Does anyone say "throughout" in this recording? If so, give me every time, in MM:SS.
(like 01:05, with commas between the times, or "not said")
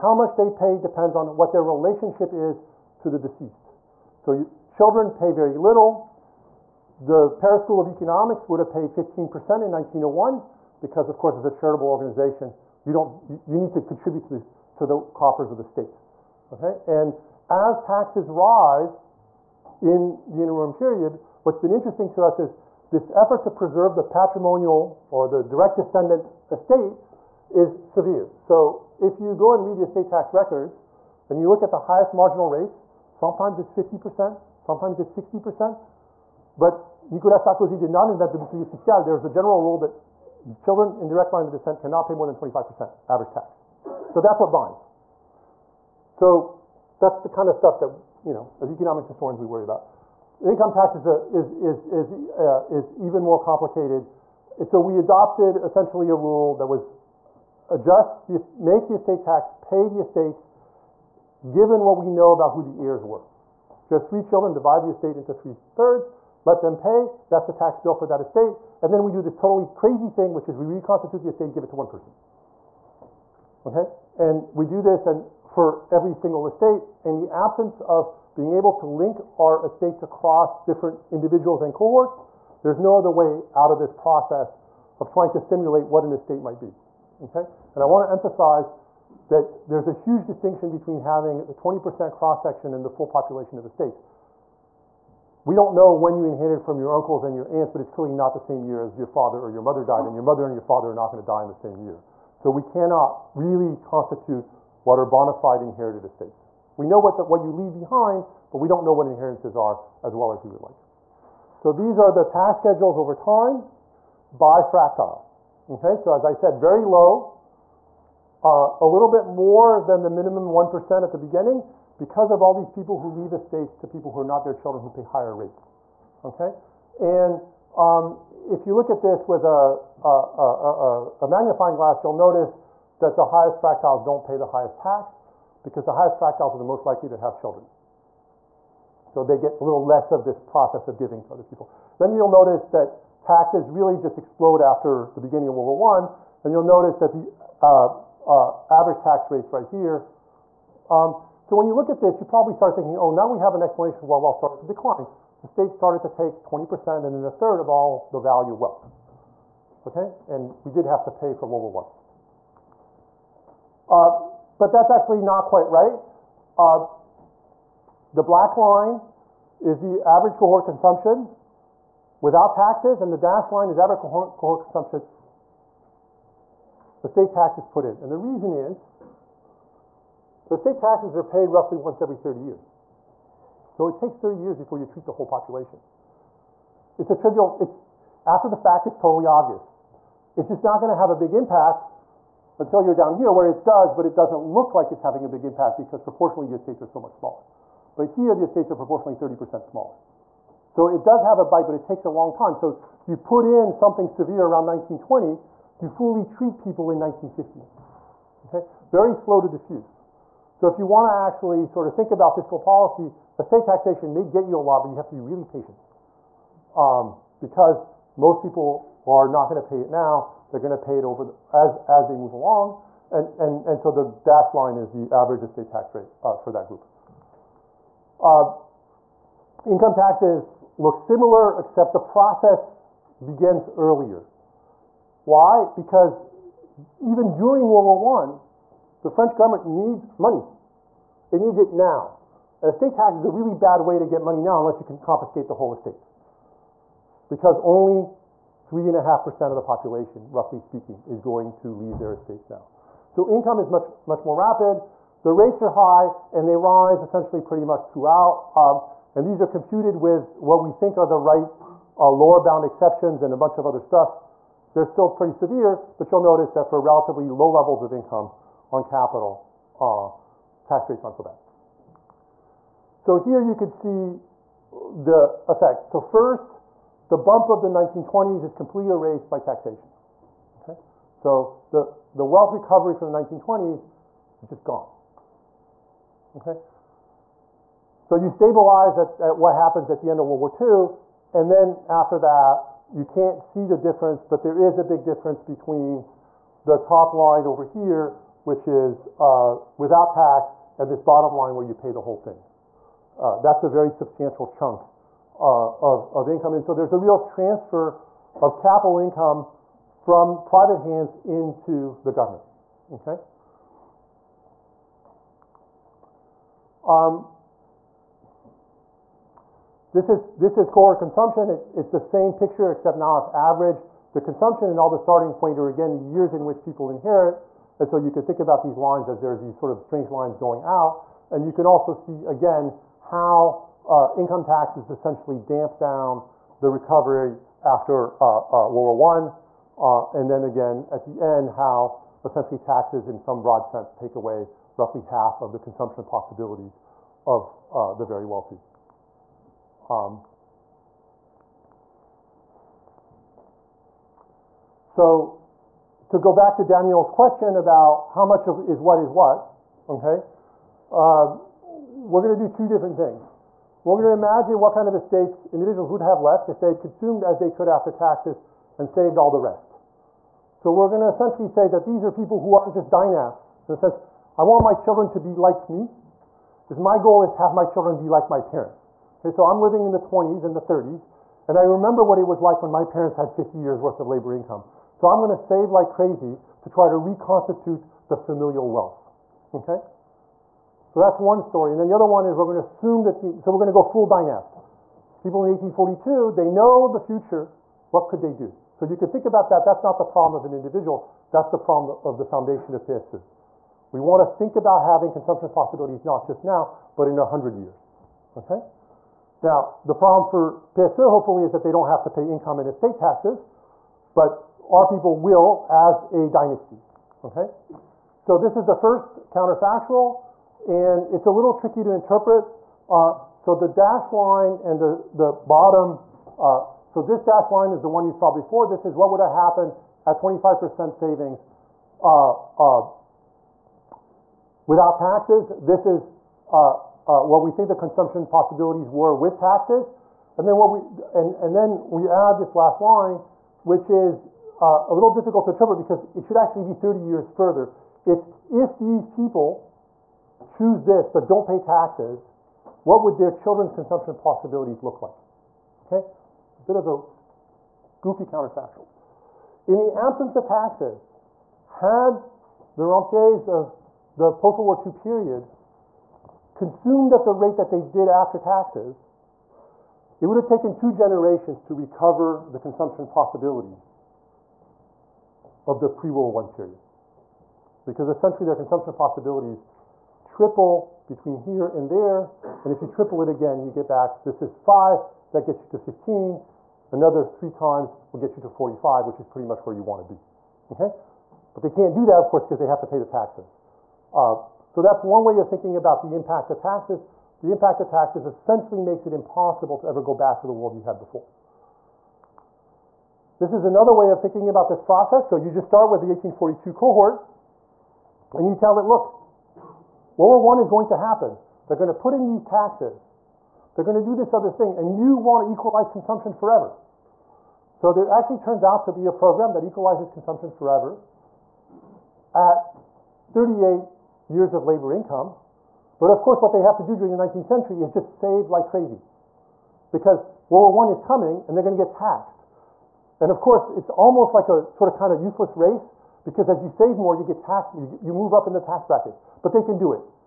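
04:17.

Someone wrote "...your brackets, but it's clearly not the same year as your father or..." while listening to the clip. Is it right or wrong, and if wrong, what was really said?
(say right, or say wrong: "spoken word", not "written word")
wrong: "aunts", not "brackets".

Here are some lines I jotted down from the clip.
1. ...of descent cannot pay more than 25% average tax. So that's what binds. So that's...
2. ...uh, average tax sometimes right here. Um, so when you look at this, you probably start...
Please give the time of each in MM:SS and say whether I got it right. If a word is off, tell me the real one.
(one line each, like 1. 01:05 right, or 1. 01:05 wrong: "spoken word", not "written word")
1. 00:41 right
2. 02:28 wrong: "rates", not "sometimes".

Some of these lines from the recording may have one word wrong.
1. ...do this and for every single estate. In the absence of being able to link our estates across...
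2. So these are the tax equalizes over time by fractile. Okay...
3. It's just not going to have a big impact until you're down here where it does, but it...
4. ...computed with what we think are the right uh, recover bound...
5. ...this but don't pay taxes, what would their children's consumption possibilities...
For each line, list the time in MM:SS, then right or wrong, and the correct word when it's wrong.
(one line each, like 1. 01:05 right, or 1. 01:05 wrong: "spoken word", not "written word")
1. 01:14 right
2. 01:51 wrong: "schedules", not "equalizes"
3. 03:10 right
4. 04:19 wrong: "lower", not "recover"
5. 07:30 right.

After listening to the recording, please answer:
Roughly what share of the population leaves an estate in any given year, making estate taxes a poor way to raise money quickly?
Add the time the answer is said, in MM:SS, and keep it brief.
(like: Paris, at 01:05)
3.5%, at 04:08.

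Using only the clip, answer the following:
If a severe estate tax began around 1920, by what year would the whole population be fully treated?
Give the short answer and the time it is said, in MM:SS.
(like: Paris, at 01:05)
1950, at 03:26.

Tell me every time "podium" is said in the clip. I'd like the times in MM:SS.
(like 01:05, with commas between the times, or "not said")
not said.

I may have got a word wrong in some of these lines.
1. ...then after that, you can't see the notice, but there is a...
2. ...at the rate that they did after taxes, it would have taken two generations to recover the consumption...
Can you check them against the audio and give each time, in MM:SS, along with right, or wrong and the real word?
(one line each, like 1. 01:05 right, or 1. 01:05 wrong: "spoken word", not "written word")
1. 04:51 wrong: "difference", not "notice"
2. 07:47 right.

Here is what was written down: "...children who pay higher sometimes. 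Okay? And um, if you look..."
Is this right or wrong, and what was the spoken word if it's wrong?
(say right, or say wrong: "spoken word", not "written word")
wrong: "rates", not "sometimes".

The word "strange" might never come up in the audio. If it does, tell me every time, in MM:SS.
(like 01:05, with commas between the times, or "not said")
05:29.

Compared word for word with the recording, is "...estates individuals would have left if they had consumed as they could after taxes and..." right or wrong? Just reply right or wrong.
right.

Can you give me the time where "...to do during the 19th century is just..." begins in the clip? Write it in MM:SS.
08:46.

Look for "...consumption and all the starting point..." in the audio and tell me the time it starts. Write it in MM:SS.
05:24.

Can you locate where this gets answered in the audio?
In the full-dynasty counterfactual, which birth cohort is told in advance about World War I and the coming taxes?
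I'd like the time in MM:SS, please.
08:26.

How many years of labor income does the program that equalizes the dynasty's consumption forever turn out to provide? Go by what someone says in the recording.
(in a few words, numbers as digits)
38.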